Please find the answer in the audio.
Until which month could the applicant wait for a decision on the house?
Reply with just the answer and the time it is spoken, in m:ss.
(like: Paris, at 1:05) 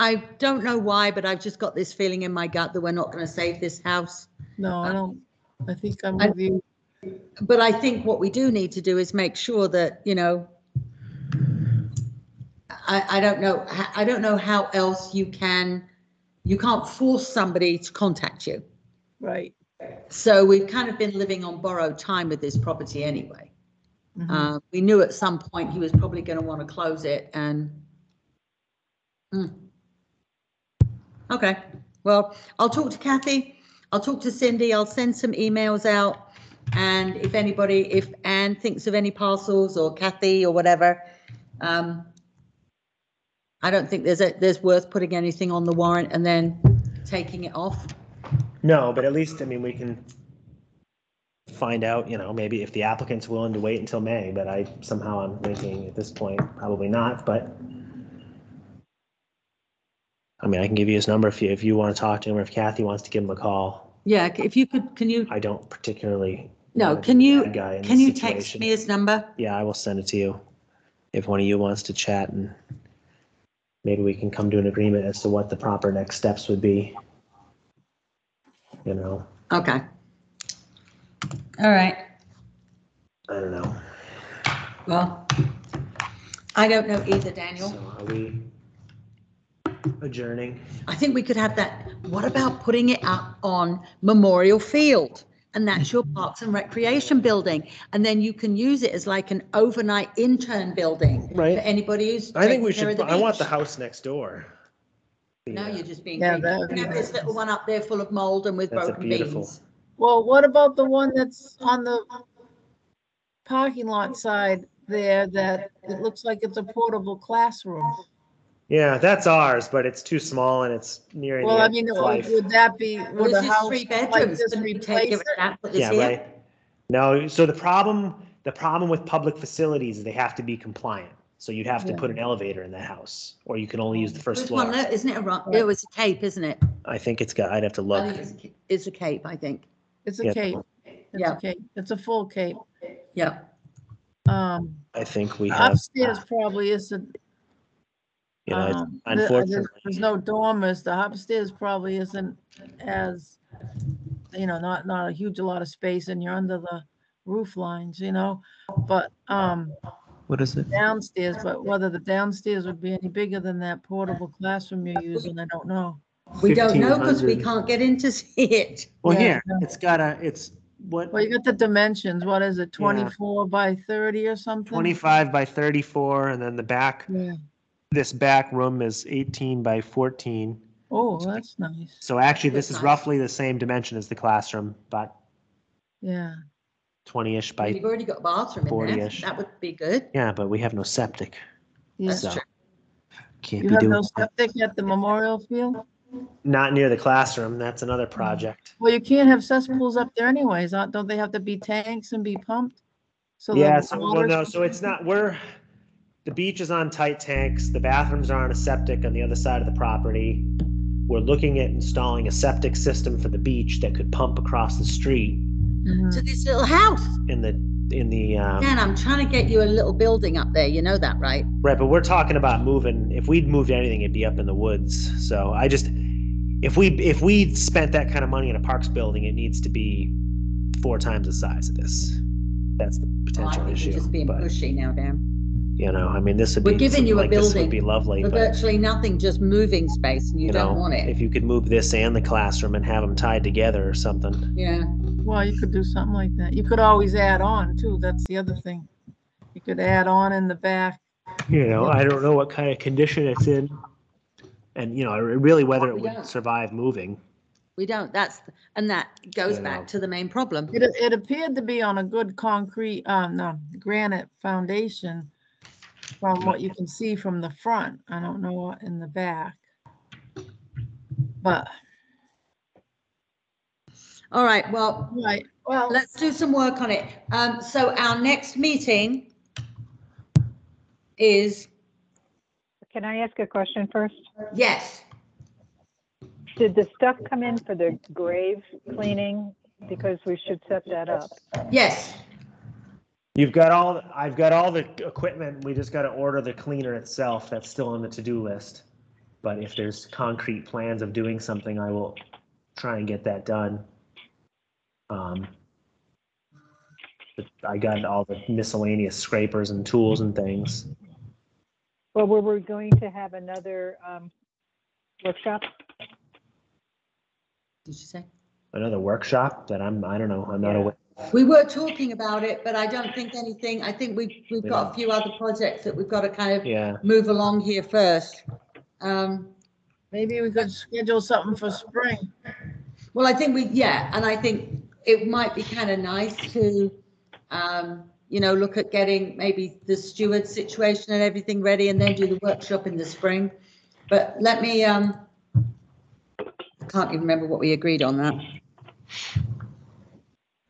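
May, at 0:54.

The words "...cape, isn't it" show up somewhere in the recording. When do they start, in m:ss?
2:15.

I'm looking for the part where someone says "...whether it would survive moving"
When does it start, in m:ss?
4:15.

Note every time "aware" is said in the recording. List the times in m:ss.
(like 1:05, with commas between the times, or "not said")
5:20.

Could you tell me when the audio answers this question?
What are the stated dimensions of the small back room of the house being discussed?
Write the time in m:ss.
2:59.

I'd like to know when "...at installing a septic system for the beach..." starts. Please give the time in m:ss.
3:31.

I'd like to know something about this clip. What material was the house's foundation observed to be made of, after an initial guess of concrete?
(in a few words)
granite.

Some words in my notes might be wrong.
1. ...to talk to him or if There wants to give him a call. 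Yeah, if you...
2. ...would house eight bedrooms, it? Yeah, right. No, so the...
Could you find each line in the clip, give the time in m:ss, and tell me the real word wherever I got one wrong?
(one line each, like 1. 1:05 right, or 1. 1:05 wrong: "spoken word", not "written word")
1. 1:01 wrong: "Kathy", not "There"
2. 2:03 wrong: "three", not "eight".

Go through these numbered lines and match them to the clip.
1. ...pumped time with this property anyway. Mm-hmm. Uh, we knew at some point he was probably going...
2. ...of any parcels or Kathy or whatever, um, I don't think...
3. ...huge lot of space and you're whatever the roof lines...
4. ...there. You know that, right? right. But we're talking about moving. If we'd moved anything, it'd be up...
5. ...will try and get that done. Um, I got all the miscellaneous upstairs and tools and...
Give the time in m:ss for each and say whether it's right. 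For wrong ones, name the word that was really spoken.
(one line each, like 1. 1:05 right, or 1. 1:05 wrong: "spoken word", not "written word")
1. 0:21 wrong: "borrowed", not "pumped"
2. 0:38 right
3. 2:35 wrong: "under", not "whatever"
4. 3:40 right
5. 5:01 wrong: "scrapers", not "upstairs".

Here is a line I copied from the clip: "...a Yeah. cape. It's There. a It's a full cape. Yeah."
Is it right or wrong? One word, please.
wrong.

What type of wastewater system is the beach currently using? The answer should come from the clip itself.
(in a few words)
tight tanks.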